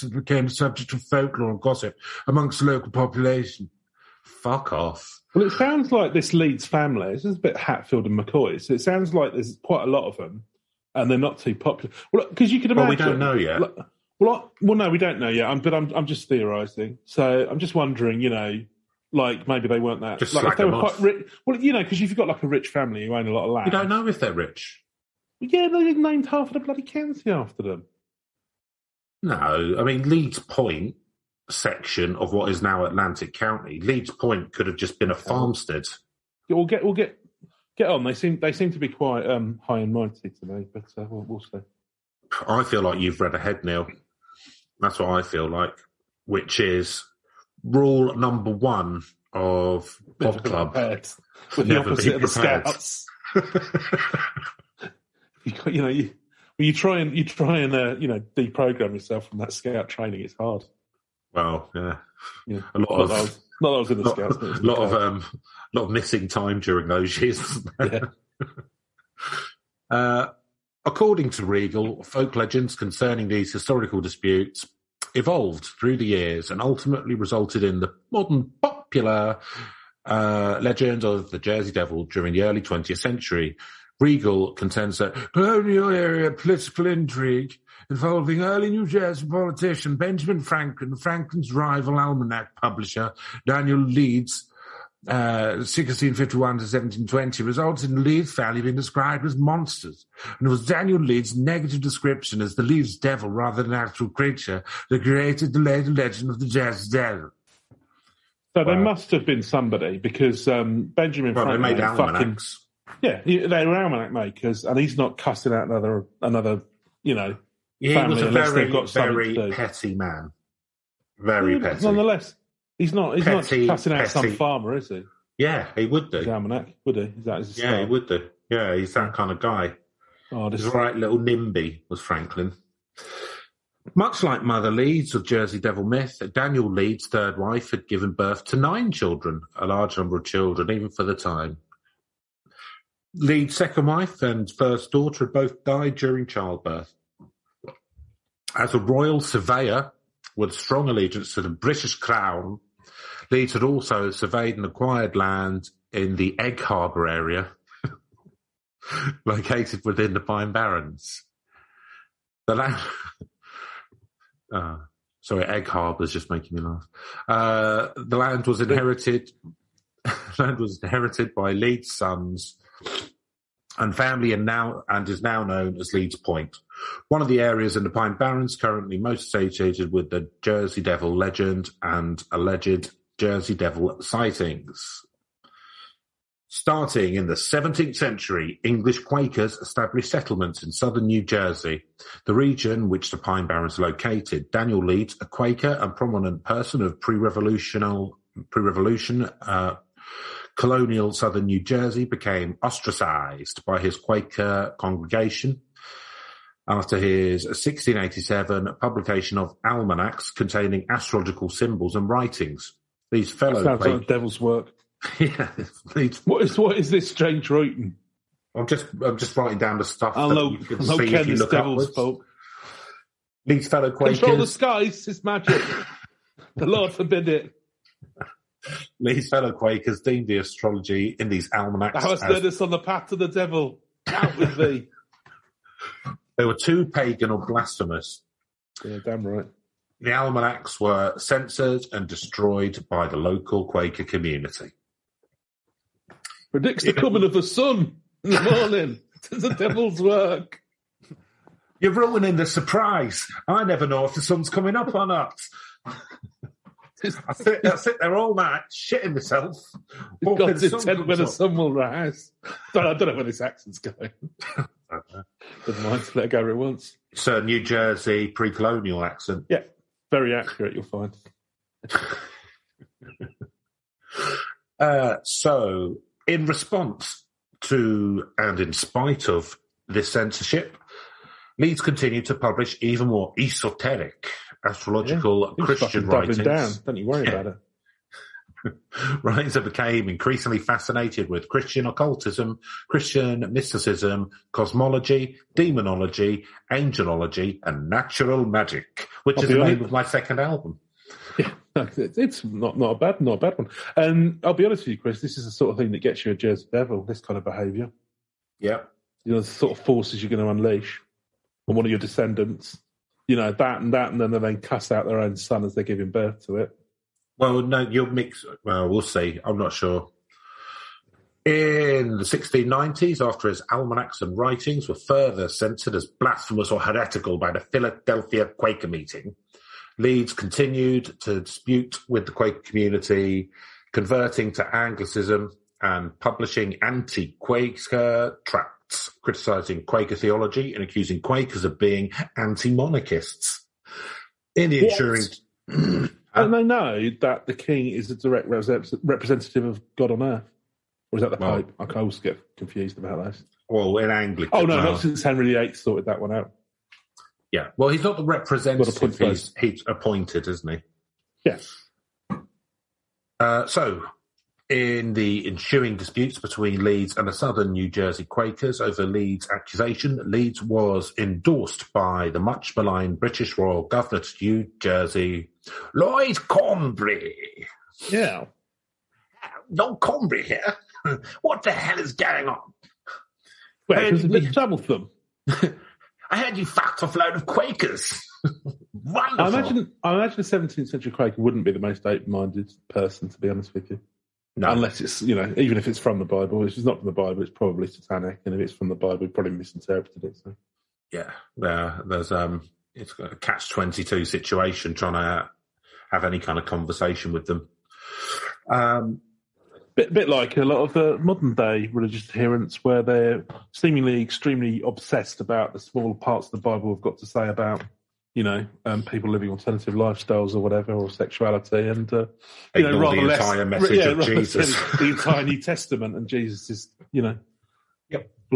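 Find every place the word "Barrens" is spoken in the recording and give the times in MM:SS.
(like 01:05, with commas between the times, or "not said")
02:40, 02:58, 03:13.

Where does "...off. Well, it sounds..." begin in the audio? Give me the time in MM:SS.
00:04.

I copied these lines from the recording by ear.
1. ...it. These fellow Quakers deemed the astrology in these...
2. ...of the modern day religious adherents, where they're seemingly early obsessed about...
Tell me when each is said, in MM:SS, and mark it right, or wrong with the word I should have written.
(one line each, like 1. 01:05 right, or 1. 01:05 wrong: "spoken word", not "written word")
1. 03:47 right
2. 06:50 wrong: "extremely", not "early".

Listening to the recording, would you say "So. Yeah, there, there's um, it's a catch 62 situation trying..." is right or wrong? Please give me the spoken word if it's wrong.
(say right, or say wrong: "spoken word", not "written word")
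wrong: "22", not "62".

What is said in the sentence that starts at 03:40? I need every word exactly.
I know, you can the know Ken devil's folk.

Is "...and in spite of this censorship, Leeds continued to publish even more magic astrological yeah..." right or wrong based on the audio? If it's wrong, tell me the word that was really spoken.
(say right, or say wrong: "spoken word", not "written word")
wrong: "esoteric", not "magic".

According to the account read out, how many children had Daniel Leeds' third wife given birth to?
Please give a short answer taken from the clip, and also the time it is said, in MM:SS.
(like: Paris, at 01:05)
9, at 02:18.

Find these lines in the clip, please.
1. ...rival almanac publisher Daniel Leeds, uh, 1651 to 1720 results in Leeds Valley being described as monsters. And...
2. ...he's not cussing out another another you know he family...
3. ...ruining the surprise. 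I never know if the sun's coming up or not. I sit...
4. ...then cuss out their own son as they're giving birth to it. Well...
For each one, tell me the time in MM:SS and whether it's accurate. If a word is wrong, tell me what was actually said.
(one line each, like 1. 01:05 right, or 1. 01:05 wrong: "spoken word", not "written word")
1. 01:31 right
2. 01:54 right
3. 04:11 right
4. 05:14 right.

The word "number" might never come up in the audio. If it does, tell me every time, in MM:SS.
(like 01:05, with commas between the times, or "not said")
00:48, 02:19.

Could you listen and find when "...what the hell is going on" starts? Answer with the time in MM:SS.
06:21.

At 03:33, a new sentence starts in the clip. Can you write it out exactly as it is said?
These fellow sounds like devil's work.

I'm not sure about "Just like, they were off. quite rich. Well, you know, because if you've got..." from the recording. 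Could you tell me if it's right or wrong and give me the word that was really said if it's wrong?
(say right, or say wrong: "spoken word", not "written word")
right.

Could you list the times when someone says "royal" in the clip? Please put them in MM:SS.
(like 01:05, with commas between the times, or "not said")
02:28, 06:13.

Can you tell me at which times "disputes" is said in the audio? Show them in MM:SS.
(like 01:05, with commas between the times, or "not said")
01:14, 05:31, 06:05.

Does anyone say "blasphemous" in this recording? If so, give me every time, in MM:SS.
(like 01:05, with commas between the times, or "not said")
03:57, 05:26.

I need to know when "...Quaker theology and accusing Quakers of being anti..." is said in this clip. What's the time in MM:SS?
05:39.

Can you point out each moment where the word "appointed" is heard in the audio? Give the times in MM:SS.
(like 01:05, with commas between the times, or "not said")
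05:59.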